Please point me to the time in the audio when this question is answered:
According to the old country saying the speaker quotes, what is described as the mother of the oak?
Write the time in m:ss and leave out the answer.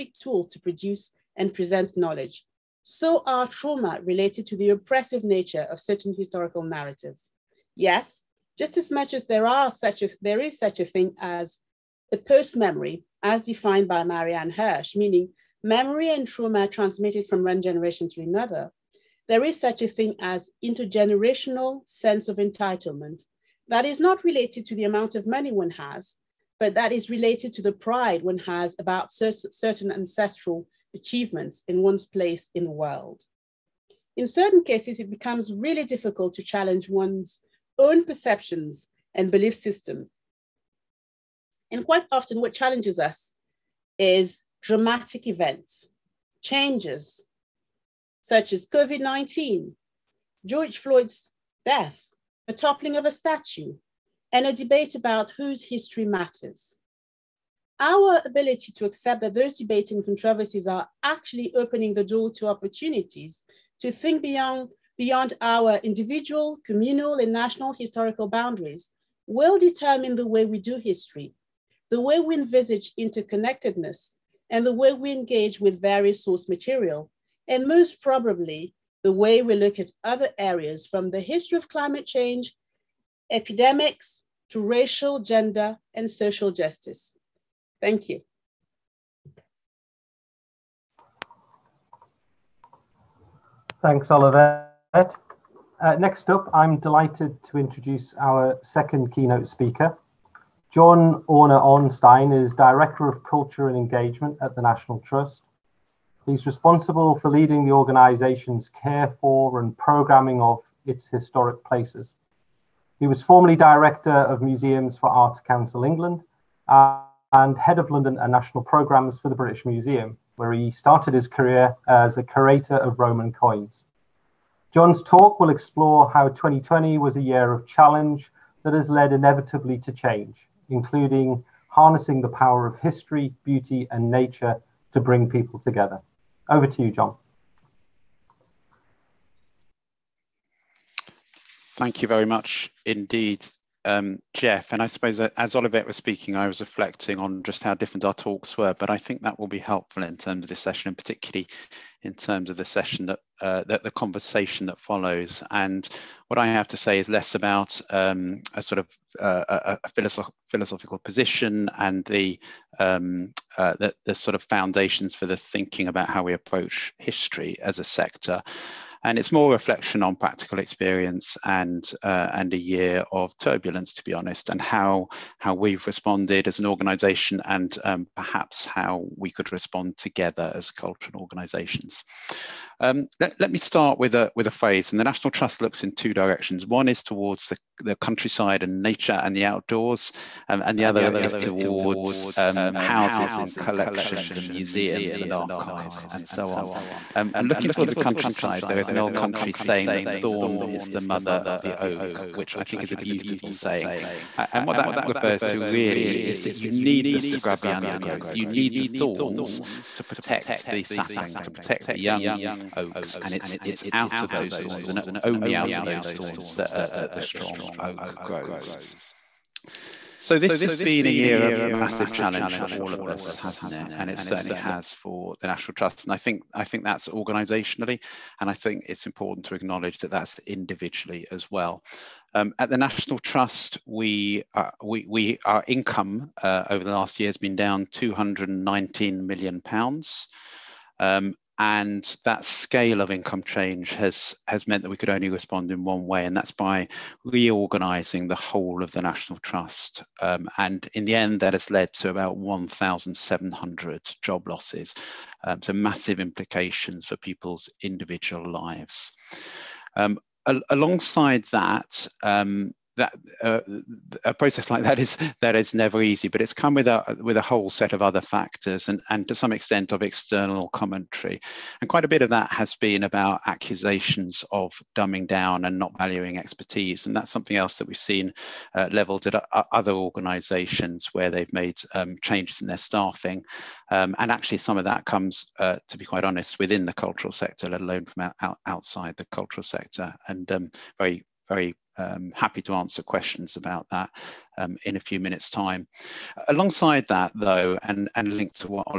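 3:20.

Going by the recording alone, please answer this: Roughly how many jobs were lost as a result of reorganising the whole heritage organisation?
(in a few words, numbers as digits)
1,700.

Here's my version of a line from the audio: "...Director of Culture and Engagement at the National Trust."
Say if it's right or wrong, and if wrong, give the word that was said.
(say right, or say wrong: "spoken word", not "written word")
right.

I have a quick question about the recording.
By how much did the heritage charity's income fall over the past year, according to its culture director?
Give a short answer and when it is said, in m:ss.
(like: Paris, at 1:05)
£219 million, at 3:57.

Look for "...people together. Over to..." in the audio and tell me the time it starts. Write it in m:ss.
2:15.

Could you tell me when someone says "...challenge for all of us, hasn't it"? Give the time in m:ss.
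3:42.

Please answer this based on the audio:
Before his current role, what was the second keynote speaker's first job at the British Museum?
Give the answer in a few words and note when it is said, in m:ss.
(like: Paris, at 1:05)
Curator of Roman coins, at 2:02.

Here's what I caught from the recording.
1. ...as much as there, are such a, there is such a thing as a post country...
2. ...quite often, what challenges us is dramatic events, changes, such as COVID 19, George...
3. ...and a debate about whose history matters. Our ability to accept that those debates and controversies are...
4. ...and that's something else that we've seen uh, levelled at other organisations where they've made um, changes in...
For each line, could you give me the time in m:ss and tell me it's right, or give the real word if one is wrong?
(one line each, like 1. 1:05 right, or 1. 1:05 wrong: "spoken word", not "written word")
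1. 0:08 wrong: "memory", not "country"
2. 0:41 right
3. 0:54 right
4. 4:37 right.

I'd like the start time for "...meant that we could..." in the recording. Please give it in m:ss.
4:04.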